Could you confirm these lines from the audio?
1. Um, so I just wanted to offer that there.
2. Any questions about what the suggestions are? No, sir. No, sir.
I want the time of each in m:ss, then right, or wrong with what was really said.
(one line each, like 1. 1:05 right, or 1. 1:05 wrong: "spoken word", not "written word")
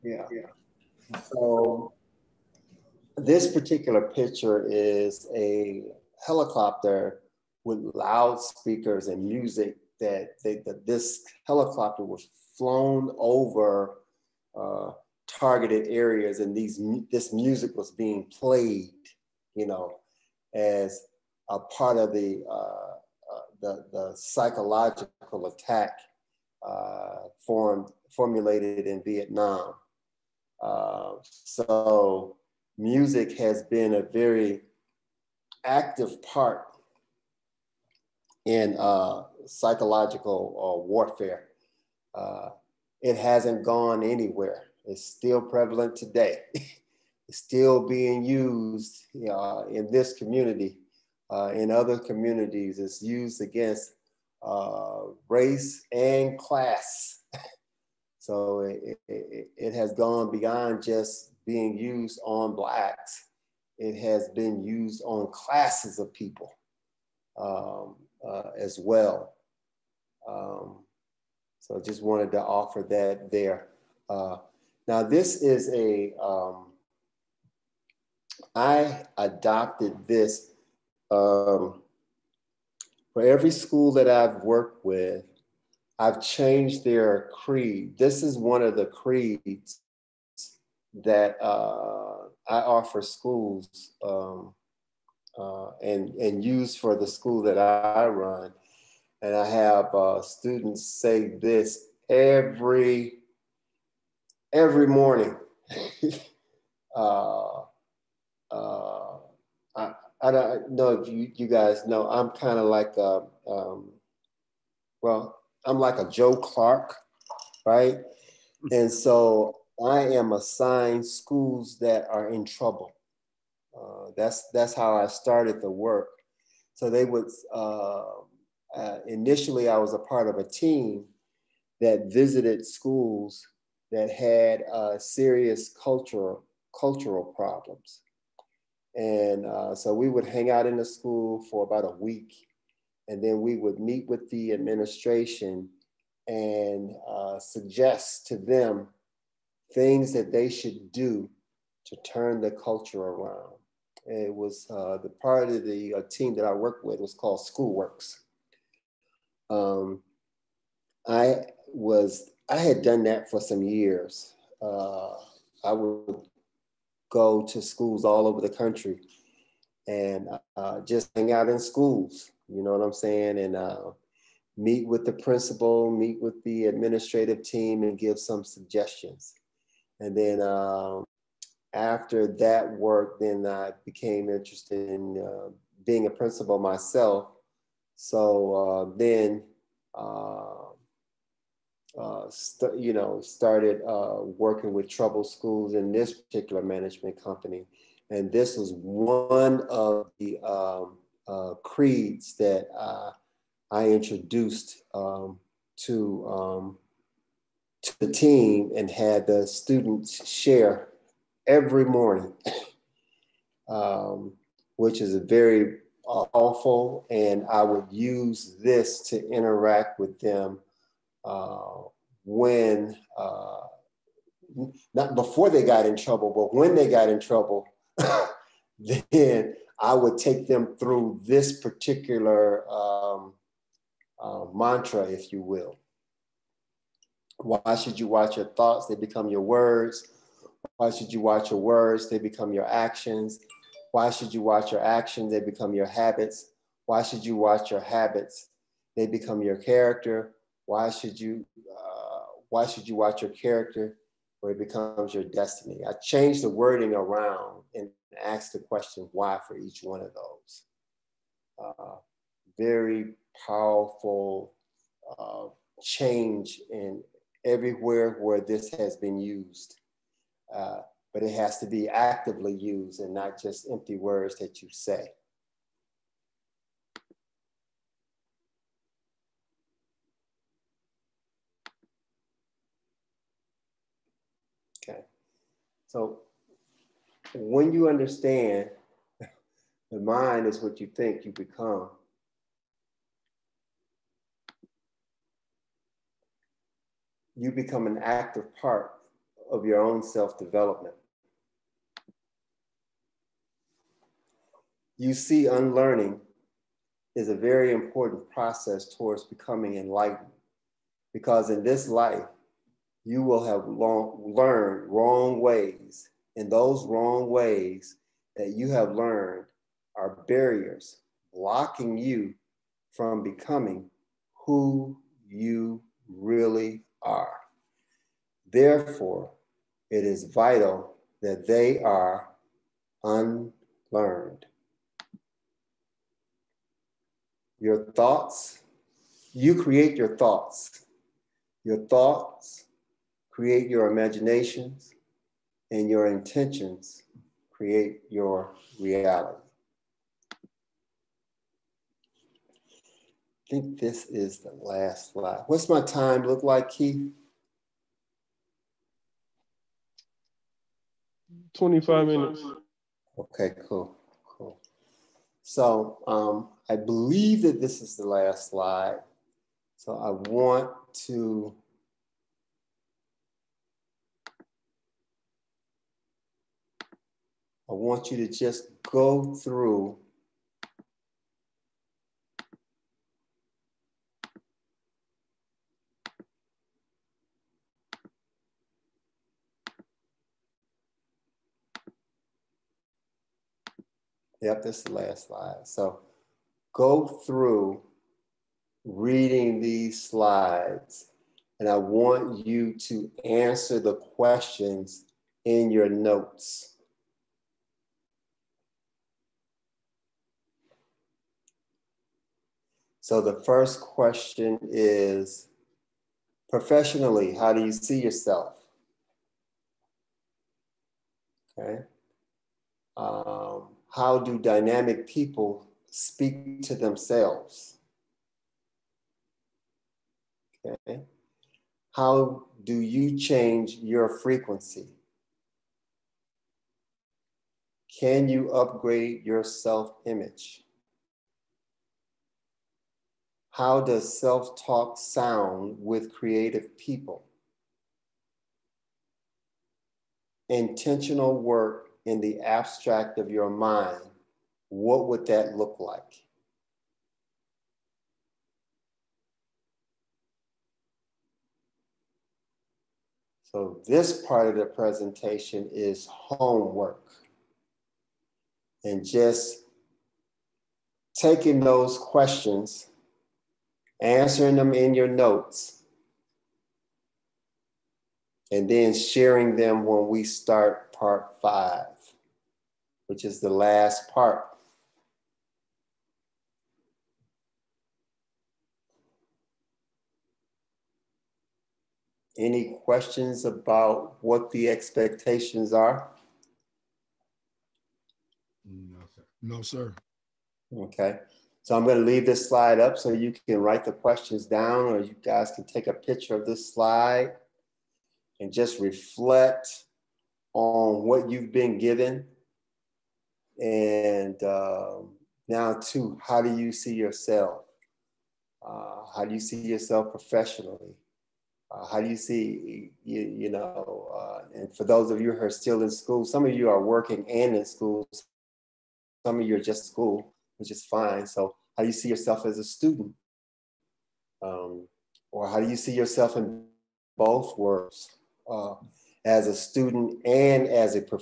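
1. 1:10 right
2. 8:12 wrong: "expectations", not "suggestions".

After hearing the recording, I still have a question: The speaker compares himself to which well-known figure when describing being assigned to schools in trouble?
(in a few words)
Joe Clark.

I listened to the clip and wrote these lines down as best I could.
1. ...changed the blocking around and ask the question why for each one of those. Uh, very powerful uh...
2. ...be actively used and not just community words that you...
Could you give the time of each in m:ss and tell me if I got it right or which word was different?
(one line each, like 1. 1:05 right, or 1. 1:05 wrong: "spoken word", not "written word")
1. 4:15 wrong: "wording", not "blocking"
2. 4:31 wrong: "empty", not "community".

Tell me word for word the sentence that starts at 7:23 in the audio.
How does self talk sound with creative people?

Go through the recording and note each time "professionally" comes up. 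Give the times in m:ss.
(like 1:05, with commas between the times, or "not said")
6:56, 8:40.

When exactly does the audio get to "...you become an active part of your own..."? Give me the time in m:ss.
4:57.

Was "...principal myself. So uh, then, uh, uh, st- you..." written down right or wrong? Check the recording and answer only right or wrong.
right.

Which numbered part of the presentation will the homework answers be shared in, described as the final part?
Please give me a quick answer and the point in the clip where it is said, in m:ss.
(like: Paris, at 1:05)
Part five, at 8:00.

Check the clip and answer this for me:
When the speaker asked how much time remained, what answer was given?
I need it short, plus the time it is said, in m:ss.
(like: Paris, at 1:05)
25 minutes, at 6:01.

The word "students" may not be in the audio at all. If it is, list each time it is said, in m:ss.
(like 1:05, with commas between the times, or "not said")
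1:40, 3:29, 8:52, 8:59.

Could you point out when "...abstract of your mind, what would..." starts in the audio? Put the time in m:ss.
7:32.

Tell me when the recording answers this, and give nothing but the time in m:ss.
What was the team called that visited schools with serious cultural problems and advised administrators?
2:37.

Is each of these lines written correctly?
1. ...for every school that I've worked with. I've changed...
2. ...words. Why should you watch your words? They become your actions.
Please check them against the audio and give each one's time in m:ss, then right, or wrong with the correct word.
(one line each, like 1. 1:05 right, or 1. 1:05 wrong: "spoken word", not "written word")
1. 1:23 right
2. 3:59 right.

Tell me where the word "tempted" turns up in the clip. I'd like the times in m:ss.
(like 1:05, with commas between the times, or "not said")
not said.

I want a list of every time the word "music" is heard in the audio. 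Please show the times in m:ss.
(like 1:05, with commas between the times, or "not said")
0:09, 0:17, 0:32.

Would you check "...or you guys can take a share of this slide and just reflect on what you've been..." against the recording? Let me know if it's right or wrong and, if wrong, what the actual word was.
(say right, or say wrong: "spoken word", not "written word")
wrong: "picture", not "share".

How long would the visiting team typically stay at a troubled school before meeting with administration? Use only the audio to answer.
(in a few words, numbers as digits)
About a week.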